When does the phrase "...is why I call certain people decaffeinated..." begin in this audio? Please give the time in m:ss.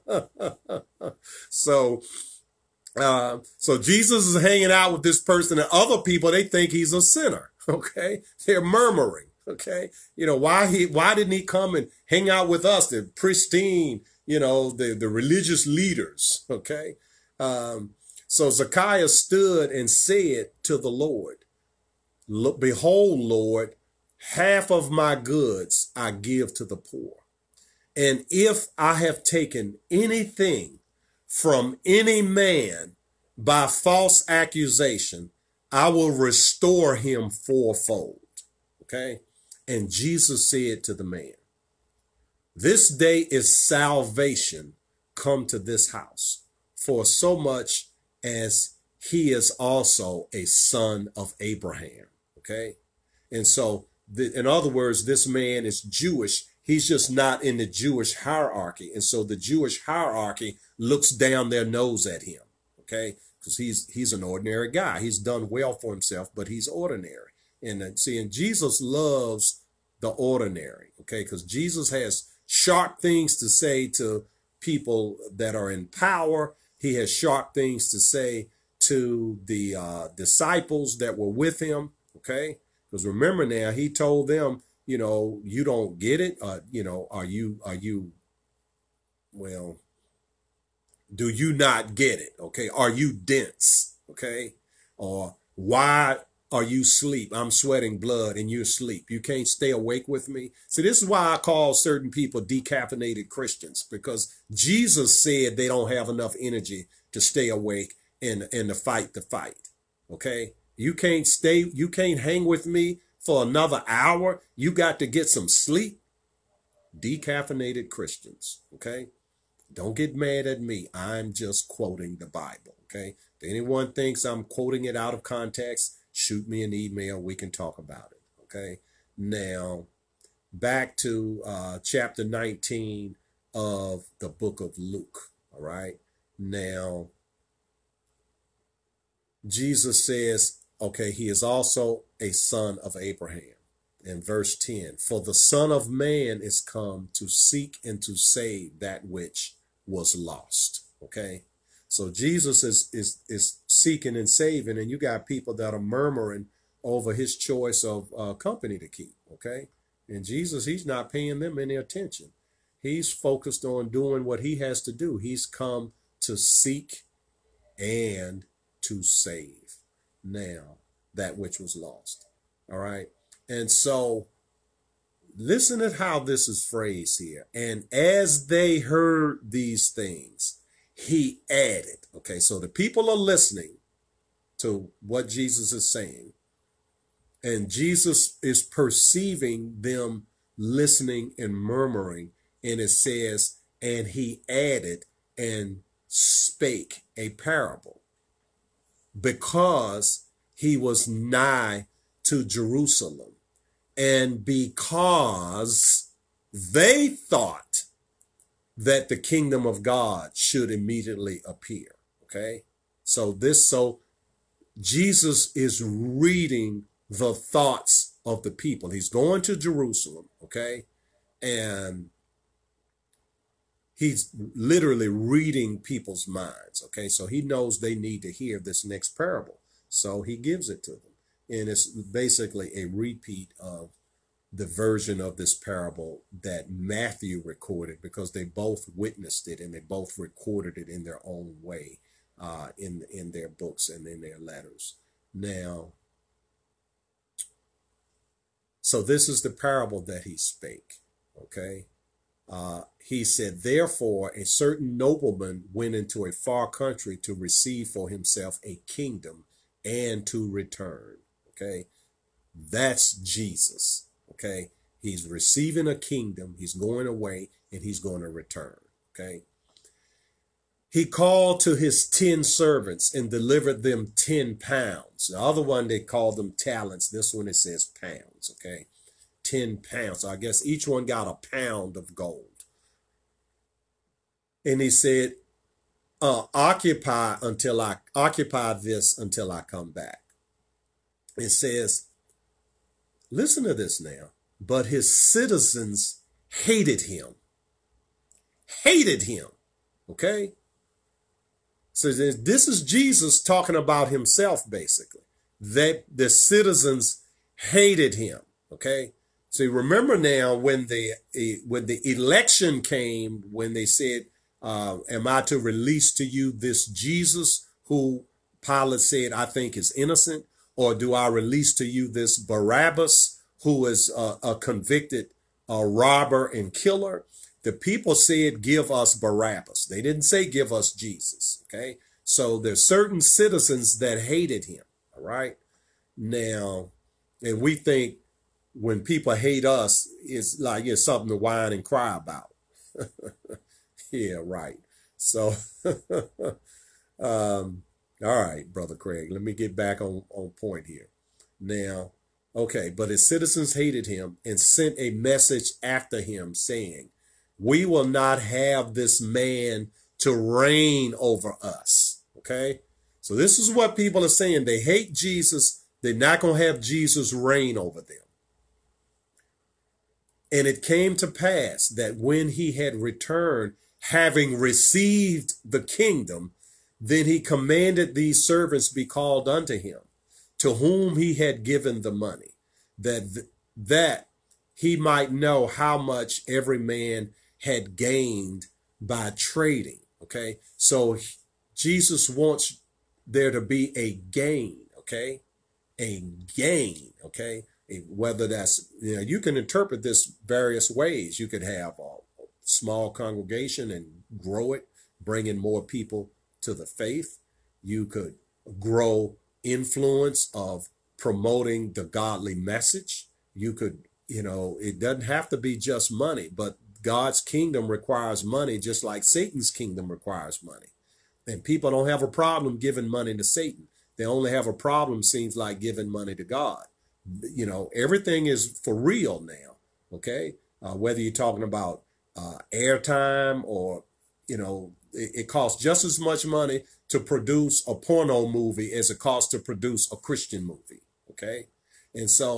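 1:41.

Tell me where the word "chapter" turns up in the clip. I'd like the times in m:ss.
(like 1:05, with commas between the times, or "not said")
2:11.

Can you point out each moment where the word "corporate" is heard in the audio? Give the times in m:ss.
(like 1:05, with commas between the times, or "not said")
not said.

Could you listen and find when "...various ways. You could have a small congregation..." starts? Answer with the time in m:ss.
6:40.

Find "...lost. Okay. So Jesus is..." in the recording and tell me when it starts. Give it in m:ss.
2:30.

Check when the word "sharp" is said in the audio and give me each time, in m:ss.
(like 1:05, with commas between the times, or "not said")
1:12, 1:17.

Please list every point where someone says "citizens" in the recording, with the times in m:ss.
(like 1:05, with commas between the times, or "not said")
4:55, 5:06, 5:33, 5:53.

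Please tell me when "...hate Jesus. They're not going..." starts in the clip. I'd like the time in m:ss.
6:04.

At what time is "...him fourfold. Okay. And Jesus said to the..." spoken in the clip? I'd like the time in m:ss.
0:36.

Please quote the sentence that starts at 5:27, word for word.
The people said, give us Barabbas.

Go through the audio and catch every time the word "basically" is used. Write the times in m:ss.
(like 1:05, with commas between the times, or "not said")
3:51, 5:04.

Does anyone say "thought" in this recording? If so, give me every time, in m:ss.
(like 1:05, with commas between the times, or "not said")
3:27, 3:37.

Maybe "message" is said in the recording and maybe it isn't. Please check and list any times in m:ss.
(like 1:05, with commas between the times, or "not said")
5:55, 6:52.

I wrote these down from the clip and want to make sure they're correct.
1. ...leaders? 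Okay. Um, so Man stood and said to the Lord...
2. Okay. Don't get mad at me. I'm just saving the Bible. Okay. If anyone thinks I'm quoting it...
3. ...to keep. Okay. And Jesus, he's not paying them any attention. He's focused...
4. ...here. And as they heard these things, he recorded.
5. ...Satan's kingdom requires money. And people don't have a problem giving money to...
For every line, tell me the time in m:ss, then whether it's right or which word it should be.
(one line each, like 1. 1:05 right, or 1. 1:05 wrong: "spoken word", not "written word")
1. 0:15 wrong: "Zechariah", not "Man"
2. 1:58 wrong: "quoting", not "saving"
3. 2:38 right
4. 2:57 wrong: "added", not "recorded"
5. 6:59 right.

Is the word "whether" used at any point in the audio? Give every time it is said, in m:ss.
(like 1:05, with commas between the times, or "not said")
6:38, 7:10.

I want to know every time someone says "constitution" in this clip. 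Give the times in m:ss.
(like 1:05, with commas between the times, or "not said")
not said.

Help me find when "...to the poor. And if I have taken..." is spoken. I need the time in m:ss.
0:26.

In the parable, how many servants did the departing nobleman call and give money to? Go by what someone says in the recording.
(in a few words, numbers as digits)
10.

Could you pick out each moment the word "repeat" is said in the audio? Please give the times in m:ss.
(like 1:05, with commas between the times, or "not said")
3:52.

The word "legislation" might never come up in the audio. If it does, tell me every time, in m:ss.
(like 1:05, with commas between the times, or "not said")
not said.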